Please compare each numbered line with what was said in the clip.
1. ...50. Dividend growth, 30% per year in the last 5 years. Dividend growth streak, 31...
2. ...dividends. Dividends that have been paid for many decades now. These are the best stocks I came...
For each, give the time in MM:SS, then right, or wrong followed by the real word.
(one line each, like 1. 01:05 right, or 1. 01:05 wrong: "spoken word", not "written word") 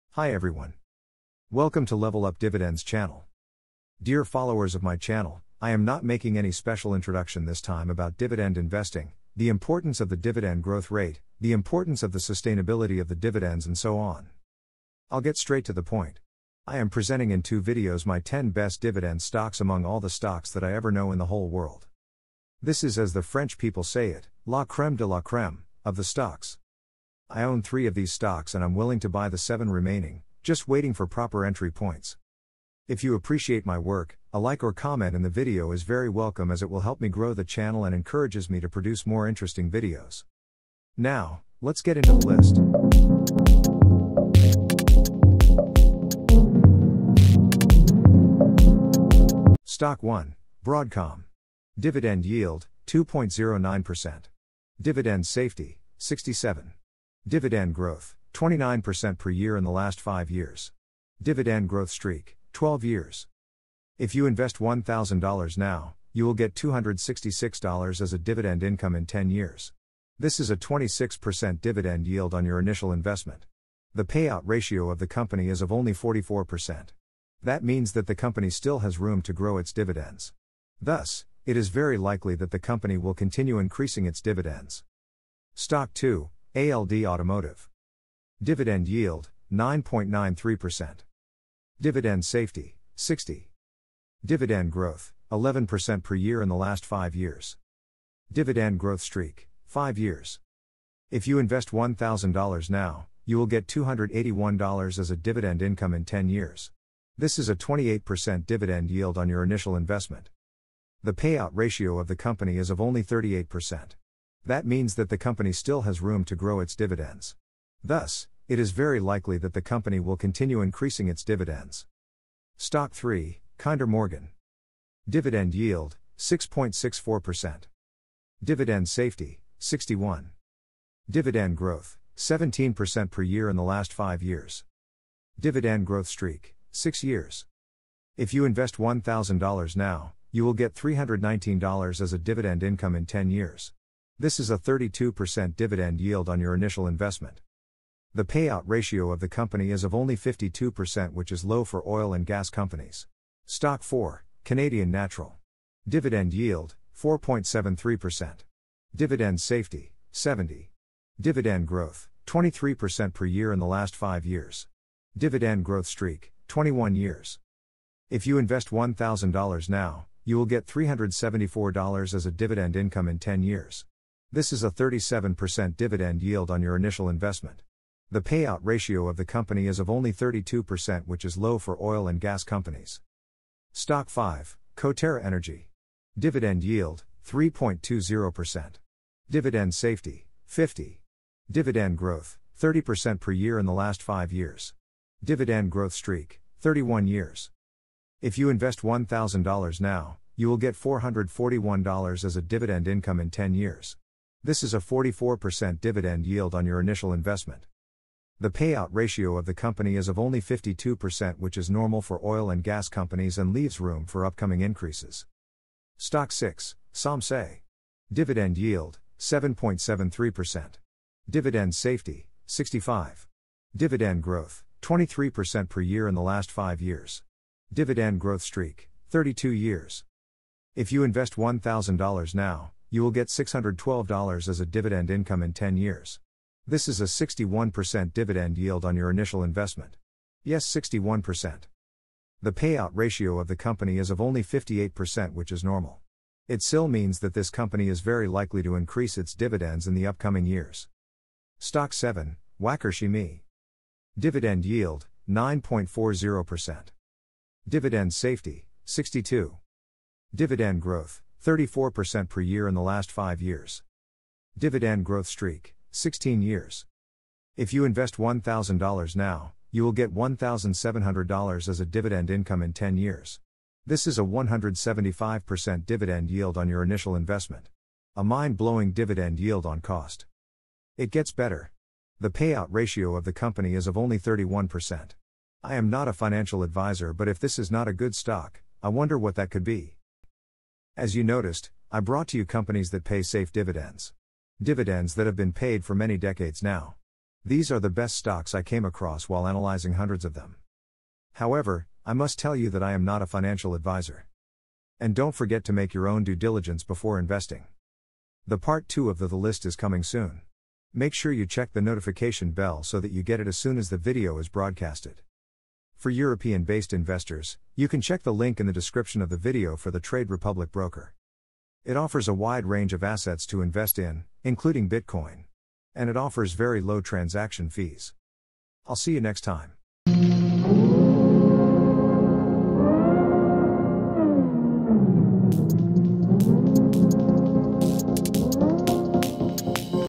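1. 03:10 right
2. 04:53 right.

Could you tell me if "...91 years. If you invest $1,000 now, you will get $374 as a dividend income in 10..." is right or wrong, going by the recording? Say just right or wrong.
wrong.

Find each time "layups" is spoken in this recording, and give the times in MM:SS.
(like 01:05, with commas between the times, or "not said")
not said.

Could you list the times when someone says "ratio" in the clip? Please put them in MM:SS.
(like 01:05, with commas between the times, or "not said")
01:14, 01:51, 02:28, 02:58, 03:28, 04:02, 04:42.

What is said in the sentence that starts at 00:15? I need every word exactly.
I'll get straight to the point.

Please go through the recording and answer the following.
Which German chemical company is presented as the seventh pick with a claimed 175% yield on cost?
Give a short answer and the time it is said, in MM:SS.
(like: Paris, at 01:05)
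Wacker Chemie, at 04:12.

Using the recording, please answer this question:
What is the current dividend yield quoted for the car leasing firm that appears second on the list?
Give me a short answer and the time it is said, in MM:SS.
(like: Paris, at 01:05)
9.93%, at 01:29.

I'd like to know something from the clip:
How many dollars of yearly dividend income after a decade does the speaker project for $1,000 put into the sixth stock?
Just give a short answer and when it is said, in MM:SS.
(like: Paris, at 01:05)
$612, at 03:53.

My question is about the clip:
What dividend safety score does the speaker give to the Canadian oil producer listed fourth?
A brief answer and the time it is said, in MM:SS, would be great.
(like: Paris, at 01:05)
70, at 02:40.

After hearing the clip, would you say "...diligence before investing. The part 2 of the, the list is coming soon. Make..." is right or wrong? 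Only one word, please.
right.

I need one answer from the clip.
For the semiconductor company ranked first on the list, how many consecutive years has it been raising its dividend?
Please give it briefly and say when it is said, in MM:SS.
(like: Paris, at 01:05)
12 years, at 01:02.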